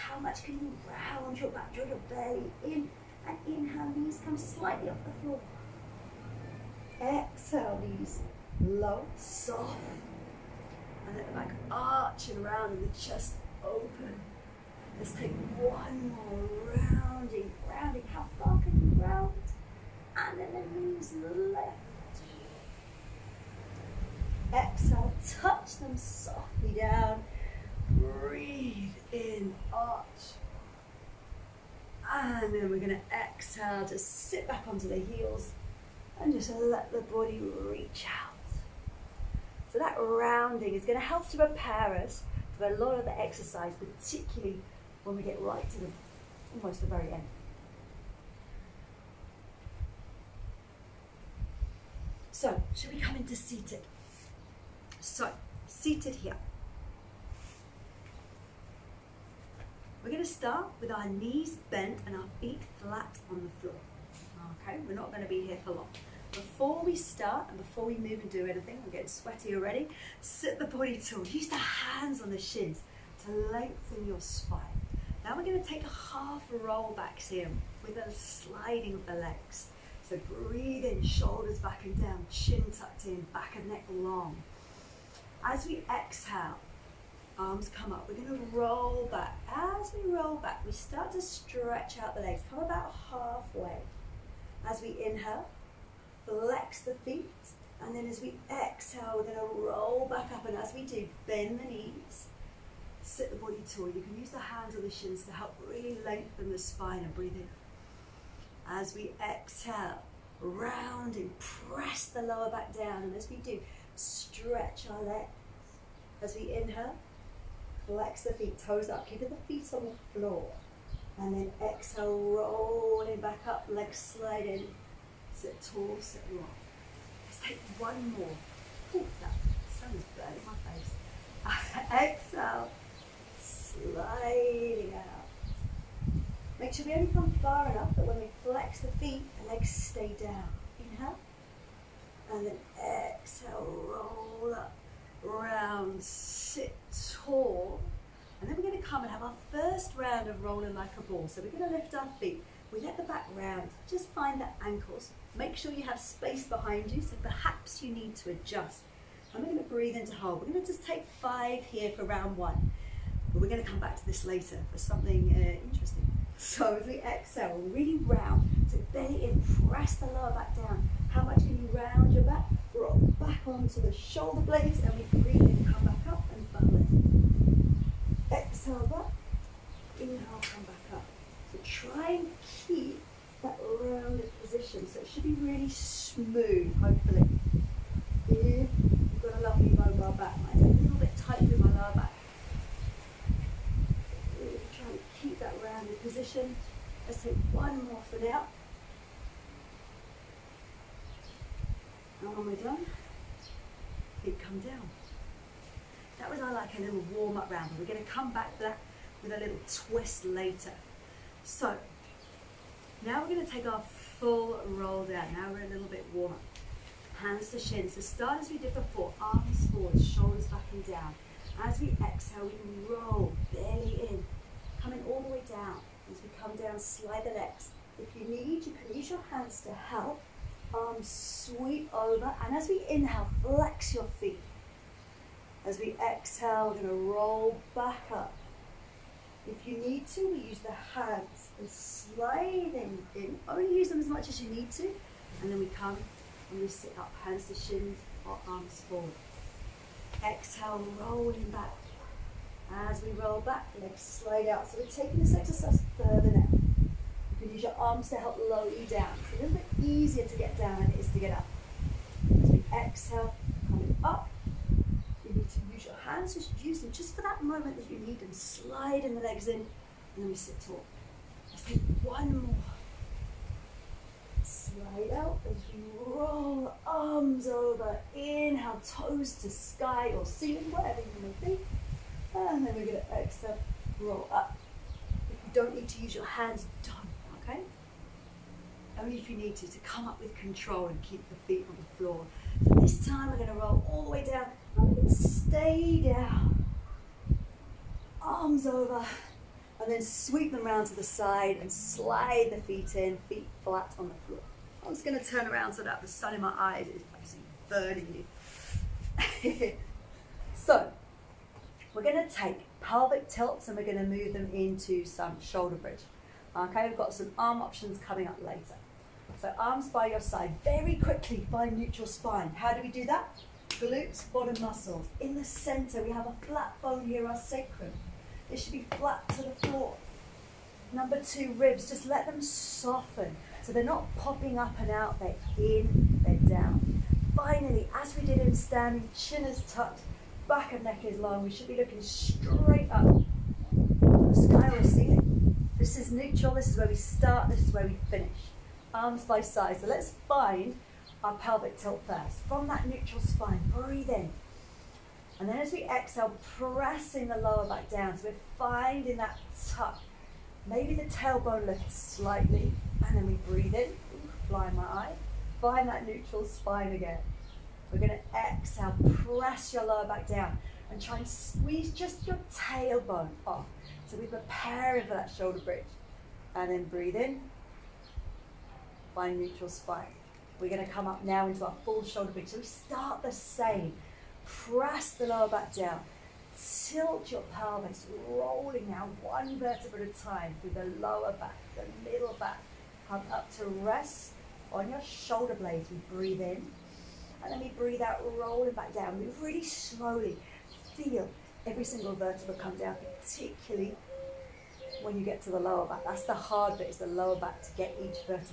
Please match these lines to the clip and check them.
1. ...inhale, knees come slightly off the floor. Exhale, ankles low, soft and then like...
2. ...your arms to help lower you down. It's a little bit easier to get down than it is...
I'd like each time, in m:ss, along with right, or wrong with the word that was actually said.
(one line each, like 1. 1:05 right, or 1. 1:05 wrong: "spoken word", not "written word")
1. 0:03 wrong: "knees", not "ankles"
2. 4:17 right.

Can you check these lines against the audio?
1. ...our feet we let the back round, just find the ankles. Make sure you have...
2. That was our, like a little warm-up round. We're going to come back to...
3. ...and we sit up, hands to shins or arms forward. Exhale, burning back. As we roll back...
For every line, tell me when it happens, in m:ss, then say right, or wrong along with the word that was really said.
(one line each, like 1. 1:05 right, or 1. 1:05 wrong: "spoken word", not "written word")
1. 2:31 right
2. 3:26 right
3. 4:06 wrong: "rolling", not "burning".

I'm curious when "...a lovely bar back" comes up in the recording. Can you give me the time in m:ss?
3:09.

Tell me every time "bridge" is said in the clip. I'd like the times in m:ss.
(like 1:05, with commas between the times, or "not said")
5:15, 6:15, 6:22.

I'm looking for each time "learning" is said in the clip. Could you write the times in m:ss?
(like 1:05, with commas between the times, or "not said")
not said.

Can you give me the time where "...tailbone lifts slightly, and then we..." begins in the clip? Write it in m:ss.
6:01.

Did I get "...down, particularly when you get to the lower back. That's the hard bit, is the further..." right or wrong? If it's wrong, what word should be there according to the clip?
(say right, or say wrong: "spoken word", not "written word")
wrong: "lower", not "further".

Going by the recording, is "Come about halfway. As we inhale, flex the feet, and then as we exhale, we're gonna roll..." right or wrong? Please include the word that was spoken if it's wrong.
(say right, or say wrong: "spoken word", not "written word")
right.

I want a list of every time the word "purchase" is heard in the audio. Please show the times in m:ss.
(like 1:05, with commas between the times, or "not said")
not said.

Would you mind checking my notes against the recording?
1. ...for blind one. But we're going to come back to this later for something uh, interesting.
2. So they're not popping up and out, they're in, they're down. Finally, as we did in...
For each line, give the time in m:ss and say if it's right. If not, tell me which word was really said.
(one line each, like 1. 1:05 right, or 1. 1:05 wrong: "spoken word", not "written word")
1. 2:41 wrong: "round", not "blind"
2. 5:33 right.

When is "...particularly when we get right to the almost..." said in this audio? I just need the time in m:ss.
0:43.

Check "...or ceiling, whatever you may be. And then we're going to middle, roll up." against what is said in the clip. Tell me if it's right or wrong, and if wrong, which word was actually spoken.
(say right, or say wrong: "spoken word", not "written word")
wrong: "exhale", not "middle".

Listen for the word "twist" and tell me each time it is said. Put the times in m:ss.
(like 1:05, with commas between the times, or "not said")
3:29.